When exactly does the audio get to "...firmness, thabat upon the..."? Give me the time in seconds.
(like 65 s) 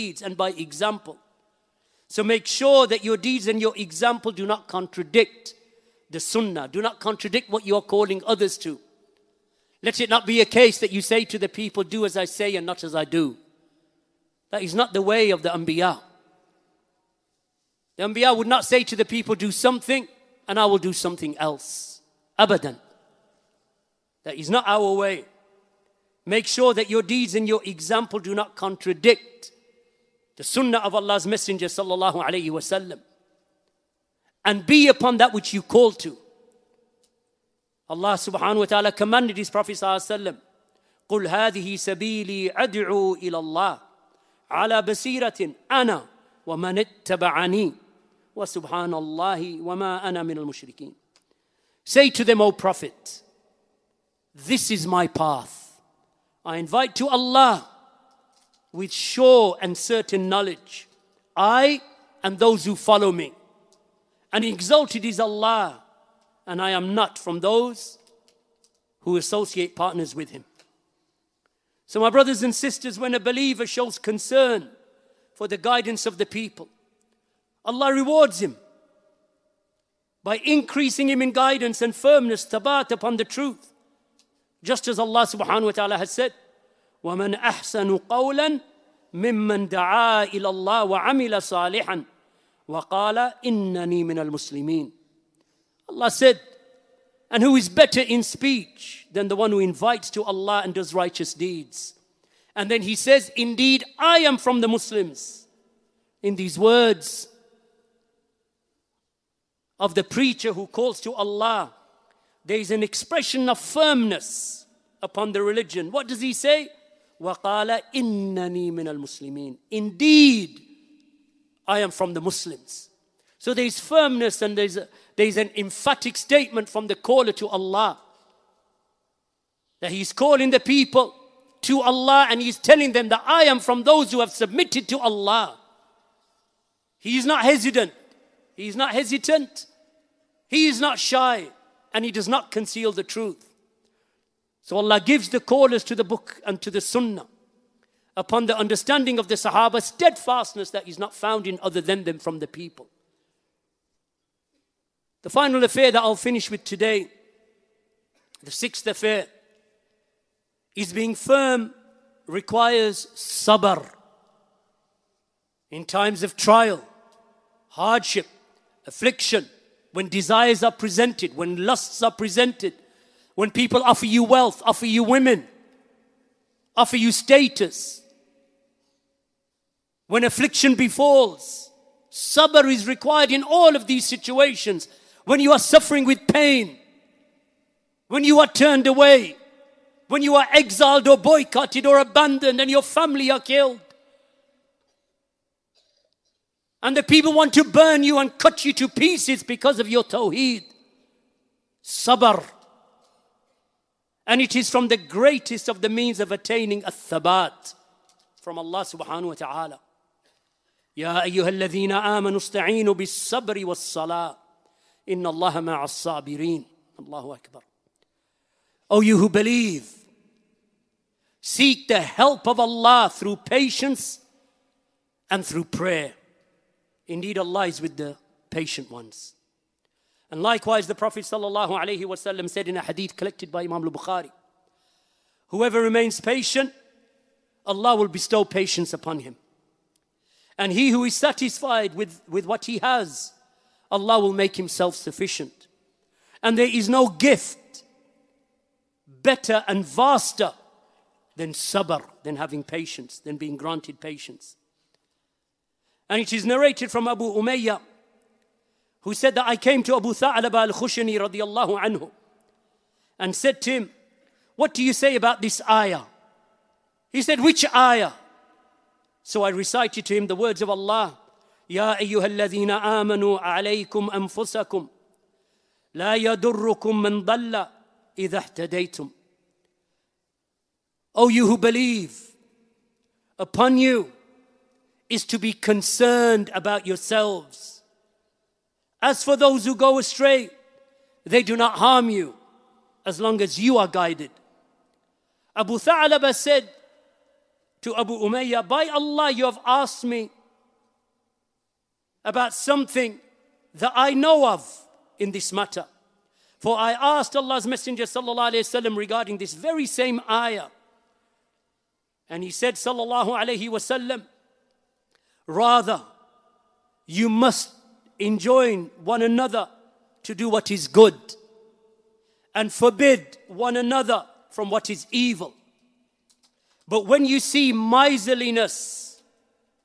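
81 s.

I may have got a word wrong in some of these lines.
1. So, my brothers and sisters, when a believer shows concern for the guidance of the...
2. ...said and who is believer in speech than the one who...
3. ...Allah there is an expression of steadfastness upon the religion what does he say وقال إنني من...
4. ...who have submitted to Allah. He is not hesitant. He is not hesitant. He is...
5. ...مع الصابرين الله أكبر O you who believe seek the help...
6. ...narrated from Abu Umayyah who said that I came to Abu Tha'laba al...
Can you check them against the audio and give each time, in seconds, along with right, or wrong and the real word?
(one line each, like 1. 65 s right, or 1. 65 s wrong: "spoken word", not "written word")
1. 71 s right
2. 96 s wrong: "better", not "believer"
3. 111 s wrong: "firmness", not "steadfastness"
4. 134 s right
5. 215 s right
6. 256 s right.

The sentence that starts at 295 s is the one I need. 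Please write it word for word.
Abu Thalabah said to Abu Umayyah, By Allah, you have asked me about something that I know of in this matter.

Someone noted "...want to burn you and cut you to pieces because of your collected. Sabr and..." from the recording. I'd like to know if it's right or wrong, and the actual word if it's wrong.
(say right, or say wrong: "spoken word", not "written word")
wrong: "tawheed", not "collected".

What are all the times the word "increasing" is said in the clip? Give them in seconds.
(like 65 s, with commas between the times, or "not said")
80 s.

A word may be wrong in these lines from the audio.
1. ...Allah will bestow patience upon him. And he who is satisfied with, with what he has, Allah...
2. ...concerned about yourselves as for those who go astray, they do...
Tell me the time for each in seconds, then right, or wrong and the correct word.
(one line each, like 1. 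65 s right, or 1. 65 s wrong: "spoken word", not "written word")
1. 237 s right
2. 285 s right.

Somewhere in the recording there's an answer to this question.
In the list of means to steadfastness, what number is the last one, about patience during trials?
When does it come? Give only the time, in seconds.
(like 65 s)
158 s.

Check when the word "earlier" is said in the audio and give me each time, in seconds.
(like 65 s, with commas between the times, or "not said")
not said.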